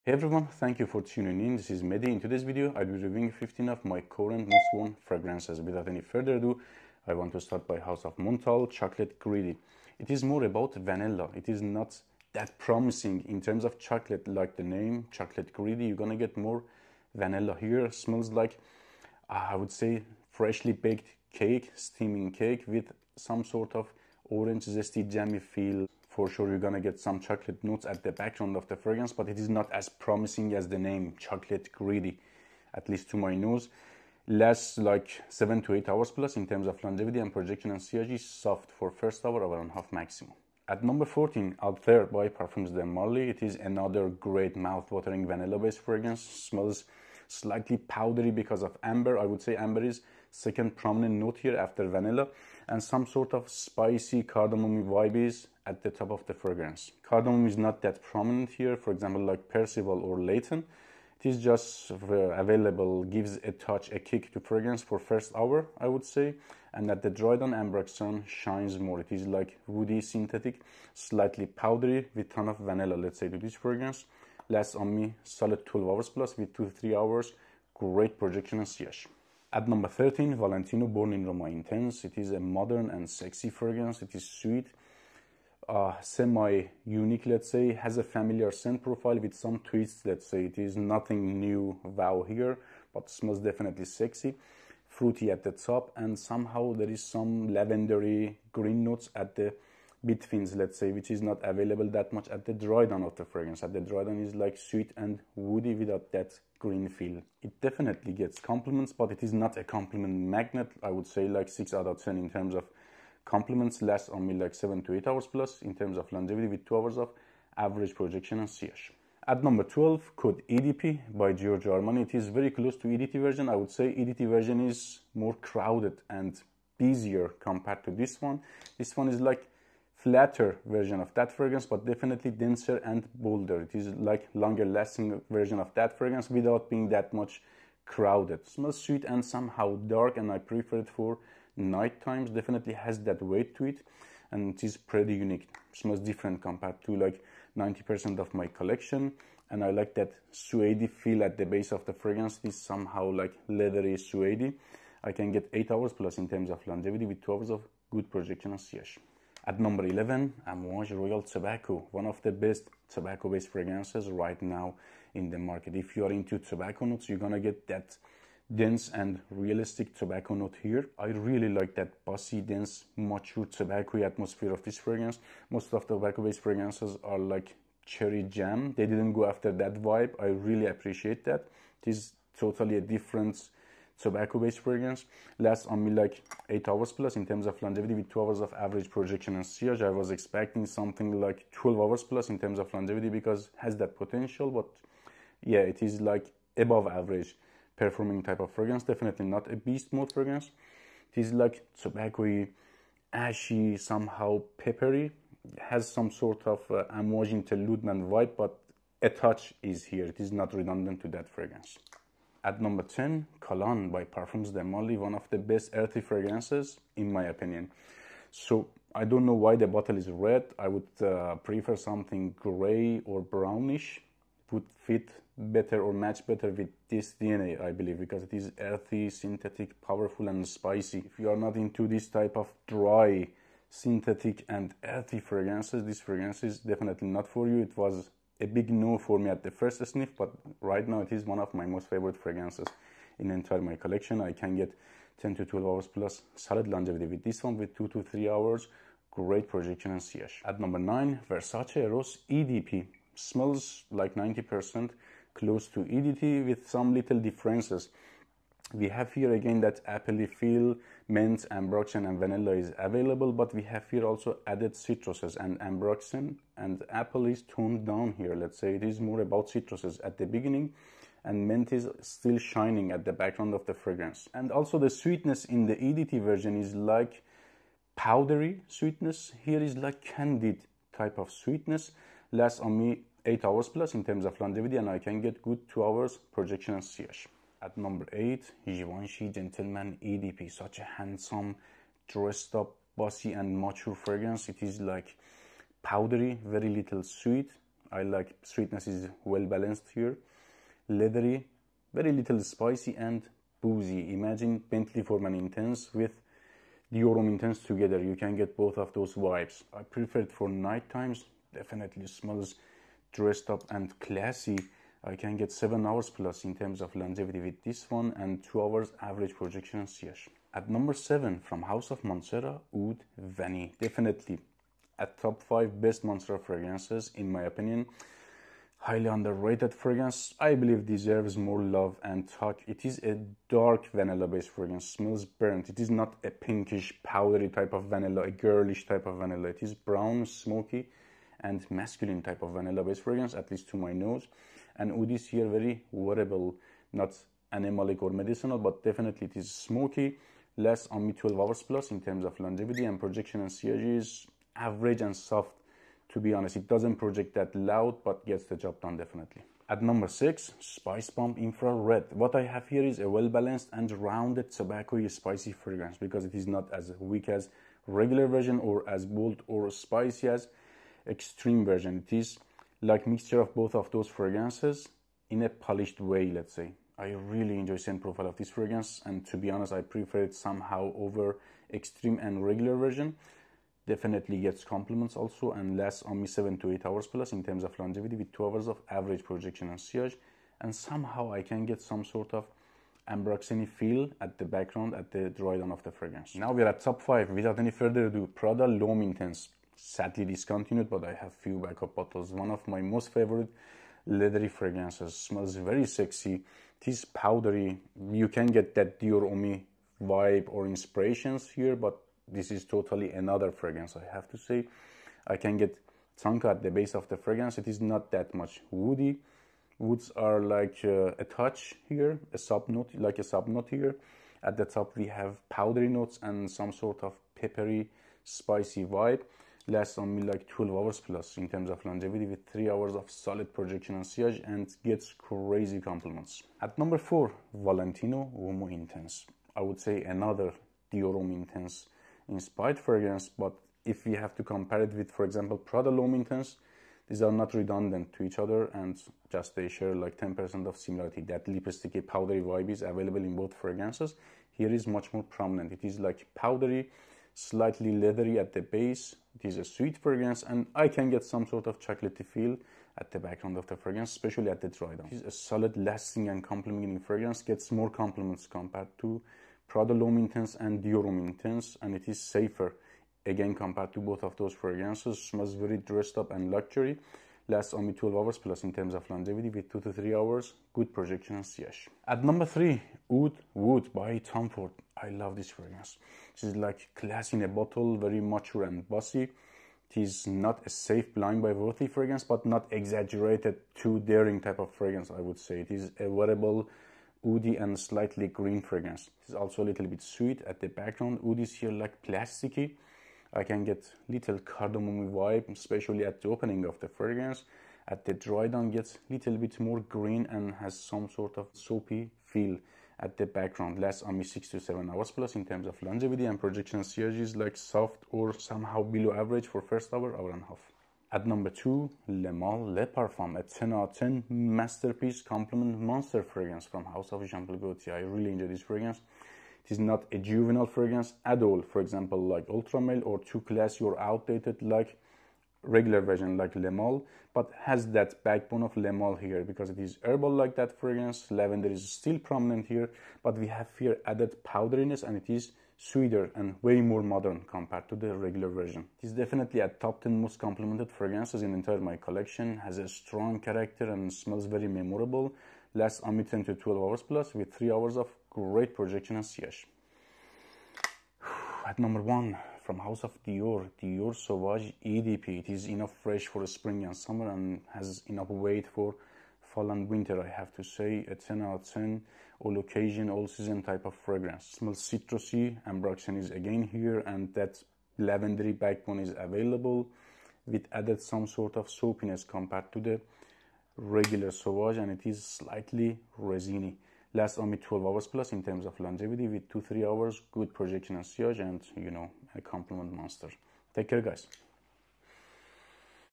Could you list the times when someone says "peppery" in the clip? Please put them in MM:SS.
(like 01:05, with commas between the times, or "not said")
03:24, 07:07.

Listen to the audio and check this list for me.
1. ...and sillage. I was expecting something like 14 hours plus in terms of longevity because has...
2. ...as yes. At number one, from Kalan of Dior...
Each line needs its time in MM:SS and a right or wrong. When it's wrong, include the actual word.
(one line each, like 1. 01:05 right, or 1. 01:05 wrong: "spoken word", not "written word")
1. 03:09 wrong: "12", not "14"
2. 09:19 wrong: "House", not "Kalan".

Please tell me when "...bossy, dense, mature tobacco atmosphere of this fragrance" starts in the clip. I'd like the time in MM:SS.
02:52.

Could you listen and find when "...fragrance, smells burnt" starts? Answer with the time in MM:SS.
05:34.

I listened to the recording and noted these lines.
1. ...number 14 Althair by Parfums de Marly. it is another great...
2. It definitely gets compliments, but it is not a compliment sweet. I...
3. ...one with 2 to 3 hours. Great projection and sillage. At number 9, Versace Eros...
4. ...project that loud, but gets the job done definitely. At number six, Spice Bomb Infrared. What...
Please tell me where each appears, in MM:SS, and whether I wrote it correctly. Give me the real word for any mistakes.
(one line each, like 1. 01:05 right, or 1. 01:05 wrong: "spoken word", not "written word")
1. 00:40 right
2. 01:47 wrong: "magnet", not "sweet"
3. 04:07 right
4. 05:56 right.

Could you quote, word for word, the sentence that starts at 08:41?
At number two, Le Male Le Parfum, a 10 out of 10 masterpiece compliment monster fragrance from House of Jean Paul Gaultier.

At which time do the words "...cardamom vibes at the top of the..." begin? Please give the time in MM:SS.
00:54.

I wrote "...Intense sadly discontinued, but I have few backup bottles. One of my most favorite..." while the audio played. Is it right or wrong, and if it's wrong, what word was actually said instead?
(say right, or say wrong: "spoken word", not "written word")
right.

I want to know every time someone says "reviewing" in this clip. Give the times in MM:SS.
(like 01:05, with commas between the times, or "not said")
00:02.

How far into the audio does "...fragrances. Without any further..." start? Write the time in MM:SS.
00:05.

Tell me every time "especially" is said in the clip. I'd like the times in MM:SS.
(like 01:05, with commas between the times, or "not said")
07:44, 08:25.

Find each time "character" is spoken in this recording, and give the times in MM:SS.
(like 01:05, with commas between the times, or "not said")
09:13.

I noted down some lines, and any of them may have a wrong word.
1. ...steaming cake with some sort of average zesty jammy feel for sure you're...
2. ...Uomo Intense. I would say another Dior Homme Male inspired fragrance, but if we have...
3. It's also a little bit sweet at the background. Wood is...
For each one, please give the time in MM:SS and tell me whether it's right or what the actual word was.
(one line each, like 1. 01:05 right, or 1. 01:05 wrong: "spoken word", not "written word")
1. 00:21 wrong: "orange", not "average"
2. 07:18 wrong: "Intense", not "Male"
3. 08:19 right.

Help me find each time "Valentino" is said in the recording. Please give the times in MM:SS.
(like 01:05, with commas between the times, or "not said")
01:20, 07:17.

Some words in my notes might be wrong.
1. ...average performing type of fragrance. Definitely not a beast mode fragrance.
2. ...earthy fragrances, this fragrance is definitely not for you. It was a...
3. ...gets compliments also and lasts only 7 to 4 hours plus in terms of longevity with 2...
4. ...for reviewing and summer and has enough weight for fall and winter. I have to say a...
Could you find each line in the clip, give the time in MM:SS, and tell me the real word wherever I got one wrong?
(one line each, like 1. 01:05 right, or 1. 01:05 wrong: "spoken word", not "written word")
1. 03:16 right
2. 03:54 right
3. 06:24 wrong: "8", not "4"
4. 09:26 wrong: "spring", not "reviewing".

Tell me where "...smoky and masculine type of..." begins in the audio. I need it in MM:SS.
05:40.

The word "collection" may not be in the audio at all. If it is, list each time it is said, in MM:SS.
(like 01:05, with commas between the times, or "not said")
02:28, 04:03, 09:11.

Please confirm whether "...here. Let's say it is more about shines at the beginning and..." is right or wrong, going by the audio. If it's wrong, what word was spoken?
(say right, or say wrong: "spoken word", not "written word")
wrong: "citruses", not "shines".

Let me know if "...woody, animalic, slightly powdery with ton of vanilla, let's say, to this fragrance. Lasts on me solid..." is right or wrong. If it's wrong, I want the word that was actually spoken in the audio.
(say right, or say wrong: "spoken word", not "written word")
wrong: "synthetic", not "animalic".